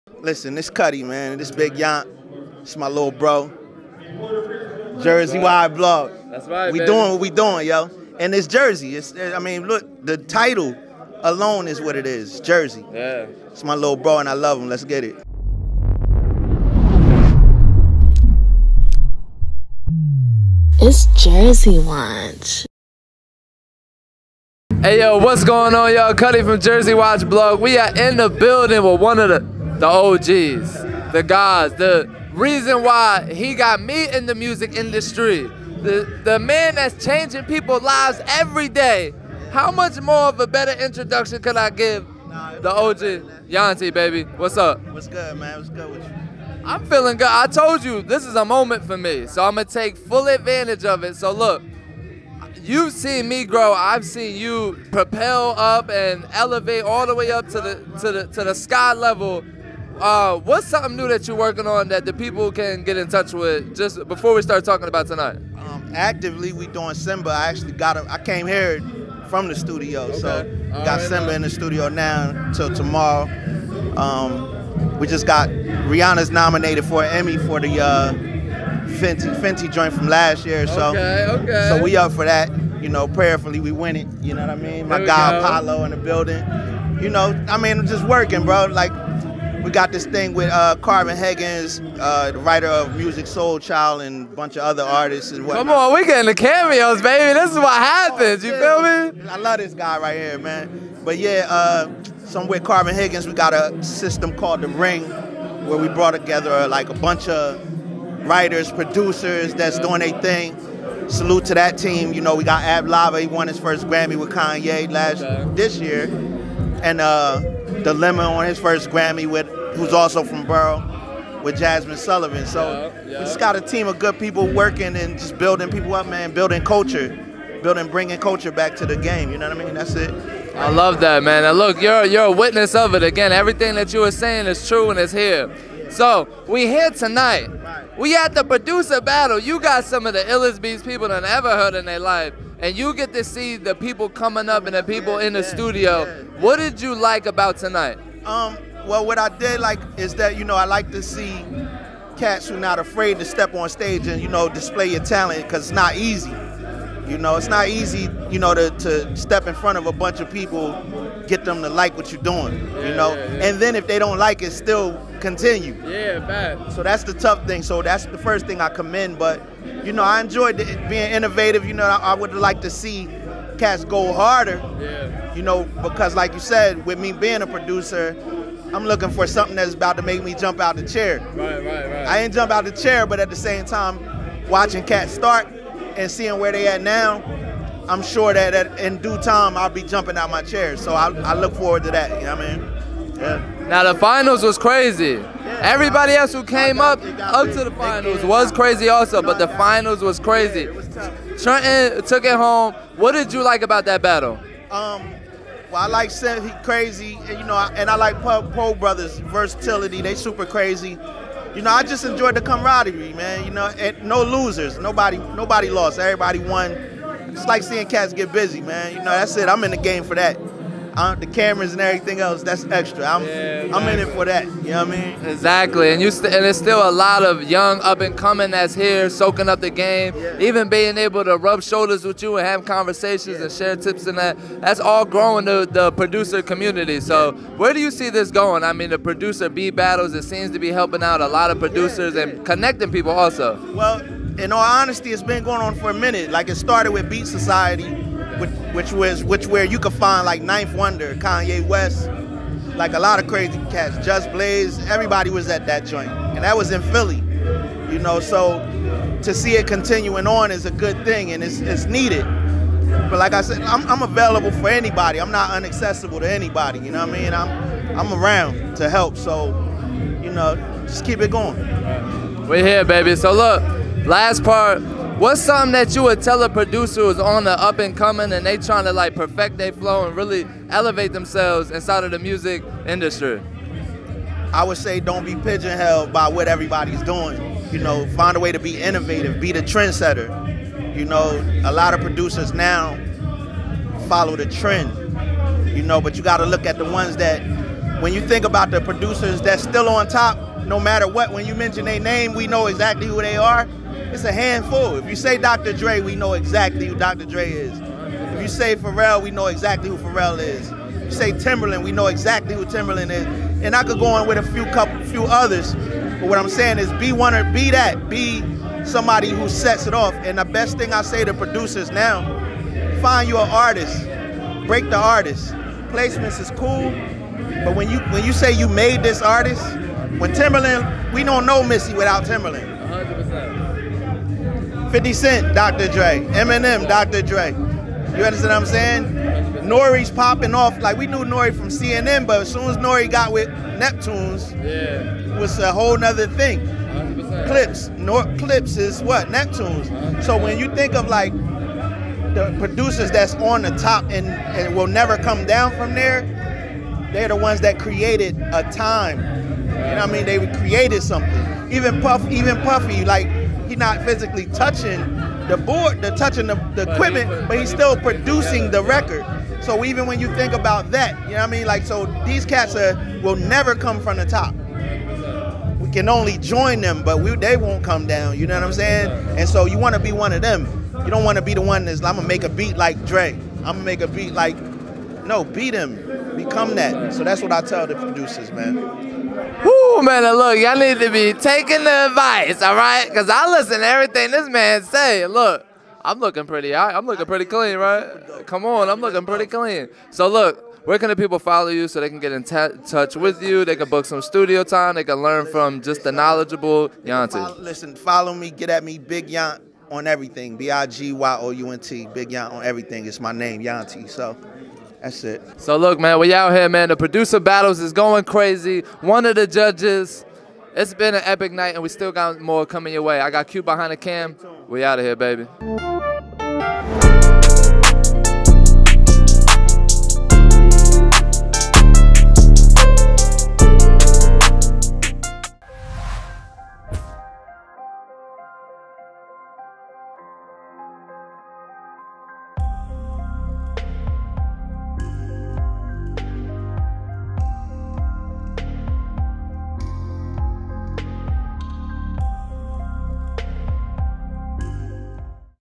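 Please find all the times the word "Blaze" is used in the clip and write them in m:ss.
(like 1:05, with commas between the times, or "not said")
4:14.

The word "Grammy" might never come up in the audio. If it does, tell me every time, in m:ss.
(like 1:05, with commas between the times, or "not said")
1:53, 1:58.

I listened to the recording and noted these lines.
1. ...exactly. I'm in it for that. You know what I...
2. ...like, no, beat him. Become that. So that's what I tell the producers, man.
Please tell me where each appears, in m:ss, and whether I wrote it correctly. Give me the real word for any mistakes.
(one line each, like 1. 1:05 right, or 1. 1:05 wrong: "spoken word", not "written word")
1. 3:43 right
2. 6:24 right.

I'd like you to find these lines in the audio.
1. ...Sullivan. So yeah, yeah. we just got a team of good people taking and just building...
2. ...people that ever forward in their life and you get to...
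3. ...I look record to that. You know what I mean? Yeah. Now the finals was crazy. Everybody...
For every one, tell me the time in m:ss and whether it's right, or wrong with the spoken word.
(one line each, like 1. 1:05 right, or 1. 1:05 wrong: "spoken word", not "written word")
1. 2:01 wrong: "working", not "taking"
2. 2:20 wrong: "heard", not "forward"
3. 3:11 wrong: "forward", not "record".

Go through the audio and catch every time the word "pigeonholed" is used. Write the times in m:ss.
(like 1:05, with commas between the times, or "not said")
4:45.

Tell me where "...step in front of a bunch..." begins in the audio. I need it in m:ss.
2:39.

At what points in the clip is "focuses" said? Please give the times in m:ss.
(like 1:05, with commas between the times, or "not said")
not said.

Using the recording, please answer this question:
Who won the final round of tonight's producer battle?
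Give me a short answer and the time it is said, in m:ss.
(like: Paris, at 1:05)
Trenton, at 3:21.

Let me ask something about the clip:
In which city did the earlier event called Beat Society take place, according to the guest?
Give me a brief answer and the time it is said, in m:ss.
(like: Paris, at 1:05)
Philly, at 4:16.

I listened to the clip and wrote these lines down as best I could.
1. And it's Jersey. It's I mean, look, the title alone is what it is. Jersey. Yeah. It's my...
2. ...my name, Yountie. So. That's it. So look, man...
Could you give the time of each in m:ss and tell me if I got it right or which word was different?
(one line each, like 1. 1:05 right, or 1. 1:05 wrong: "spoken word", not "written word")
1. 0:08 right
2. 6:53 right.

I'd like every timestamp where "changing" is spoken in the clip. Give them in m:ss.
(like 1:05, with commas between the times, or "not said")
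0:37.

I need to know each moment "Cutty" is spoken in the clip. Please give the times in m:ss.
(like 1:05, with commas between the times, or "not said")
0:00, 0:26.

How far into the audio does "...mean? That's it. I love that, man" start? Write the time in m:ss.
2:09.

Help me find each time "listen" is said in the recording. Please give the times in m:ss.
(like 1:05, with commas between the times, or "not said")
0:00, 6:33, 6:47.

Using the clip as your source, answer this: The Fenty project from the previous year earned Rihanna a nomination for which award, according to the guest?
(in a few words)
Emmy.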